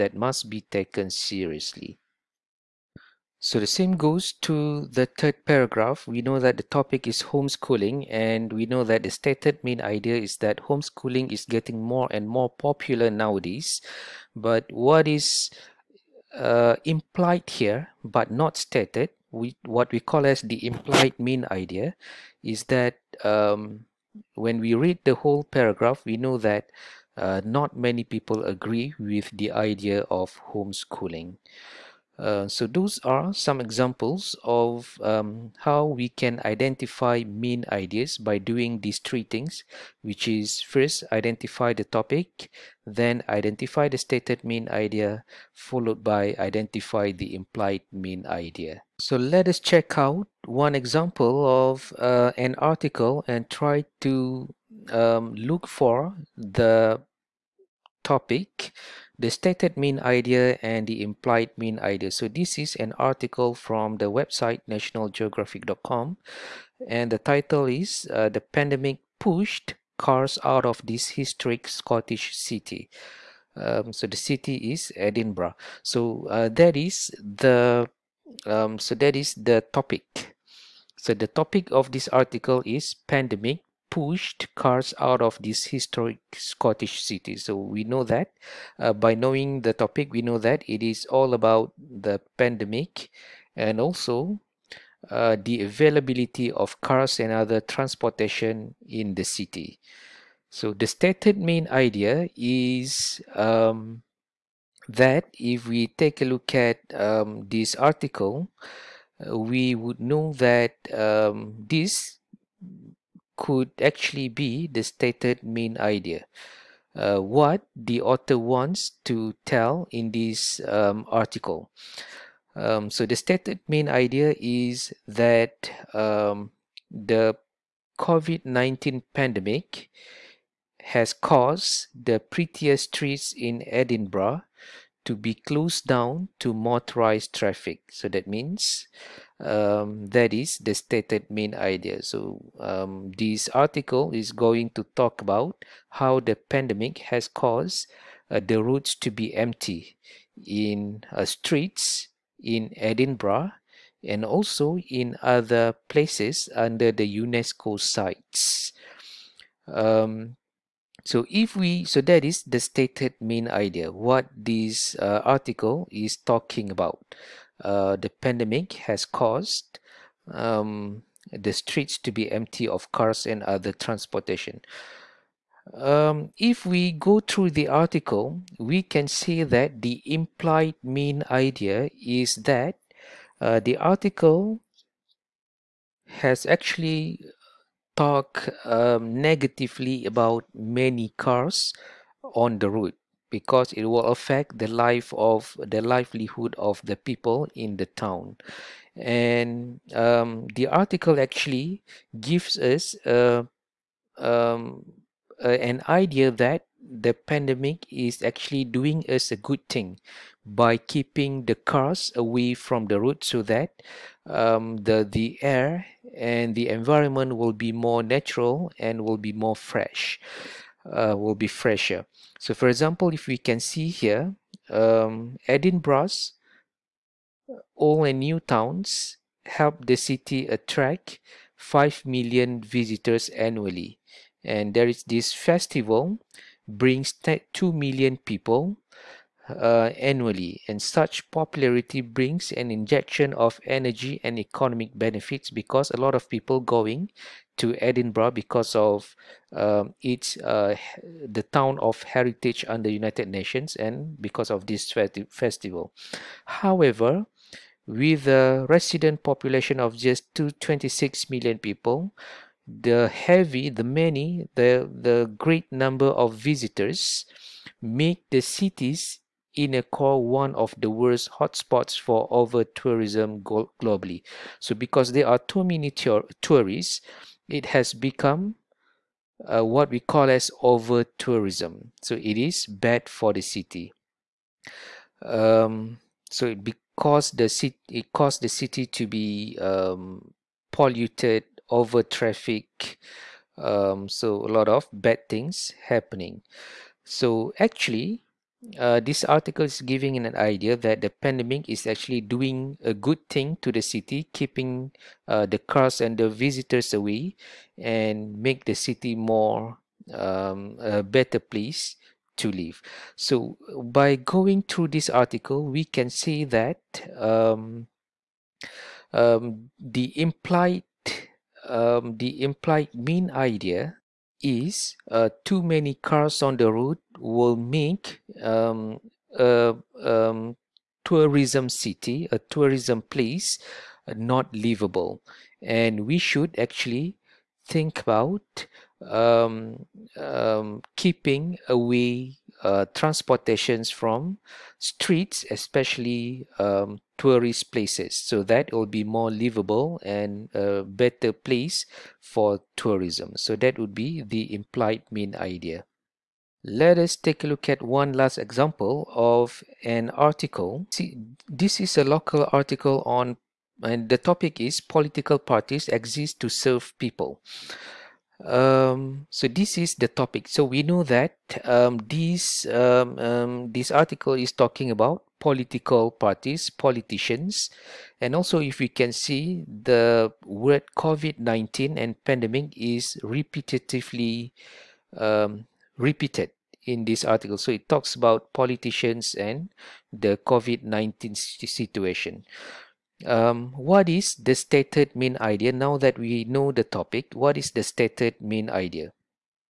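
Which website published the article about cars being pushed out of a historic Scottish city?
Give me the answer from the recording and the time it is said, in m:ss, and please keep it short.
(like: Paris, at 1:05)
nationalgeographic.com, at 1:04.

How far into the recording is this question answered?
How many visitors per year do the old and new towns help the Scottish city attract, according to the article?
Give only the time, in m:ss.
3:51.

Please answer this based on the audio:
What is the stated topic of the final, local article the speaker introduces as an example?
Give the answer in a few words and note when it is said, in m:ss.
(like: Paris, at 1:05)
political parties exist to serve people, at 6:04.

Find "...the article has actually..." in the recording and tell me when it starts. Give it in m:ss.
3:03.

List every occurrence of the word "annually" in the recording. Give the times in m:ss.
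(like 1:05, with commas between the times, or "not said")
3:53, 3:59.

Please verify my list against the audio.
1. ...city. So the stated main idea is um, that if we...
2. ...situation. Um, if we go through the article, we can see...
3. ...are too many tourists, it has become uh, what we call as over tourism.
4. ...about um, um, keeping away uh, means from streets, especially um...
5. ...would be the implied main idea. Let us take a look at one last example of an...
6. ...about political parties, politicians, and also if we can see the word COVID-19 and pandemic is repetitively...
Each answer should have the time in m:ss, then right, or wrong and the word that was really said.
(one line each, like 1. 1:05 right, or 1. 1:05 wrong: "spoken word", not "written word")
1. 1:39 right
2. 2:53 wrong: "transportation", not "situation"
3. 4:35 right
4. 5:38 wrong: "transportations", not "means"
5. 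5:53 right
6. 6:14 right.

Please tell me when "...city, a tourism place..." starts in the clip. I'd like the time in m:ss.
5:31.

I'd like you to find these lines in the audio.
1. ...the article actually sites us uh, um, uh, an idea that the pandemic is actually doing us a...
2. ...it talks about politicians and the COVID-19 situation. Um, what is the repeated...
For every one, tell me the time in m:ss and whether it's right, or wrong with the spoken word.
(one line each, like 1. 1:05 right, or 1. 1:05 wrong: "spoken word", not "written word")
1. 3:20 wrong: "gives", not "sites"
2. 6:27 wrong: "stated", not "repeated".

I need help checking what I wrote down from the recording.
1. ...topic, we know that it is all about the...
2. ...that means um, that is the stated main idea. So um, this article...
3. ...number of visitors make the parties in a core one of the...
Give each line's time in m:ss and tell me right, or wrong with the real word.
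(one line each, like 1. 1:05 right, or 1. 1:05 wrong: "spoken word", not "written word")
1. 1:29 right
2. 2:18 right
3. 4:25 wrong: "cities", not "parties".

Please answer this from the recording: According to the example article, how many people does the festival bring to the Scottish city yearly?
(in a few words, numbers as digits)
2 million.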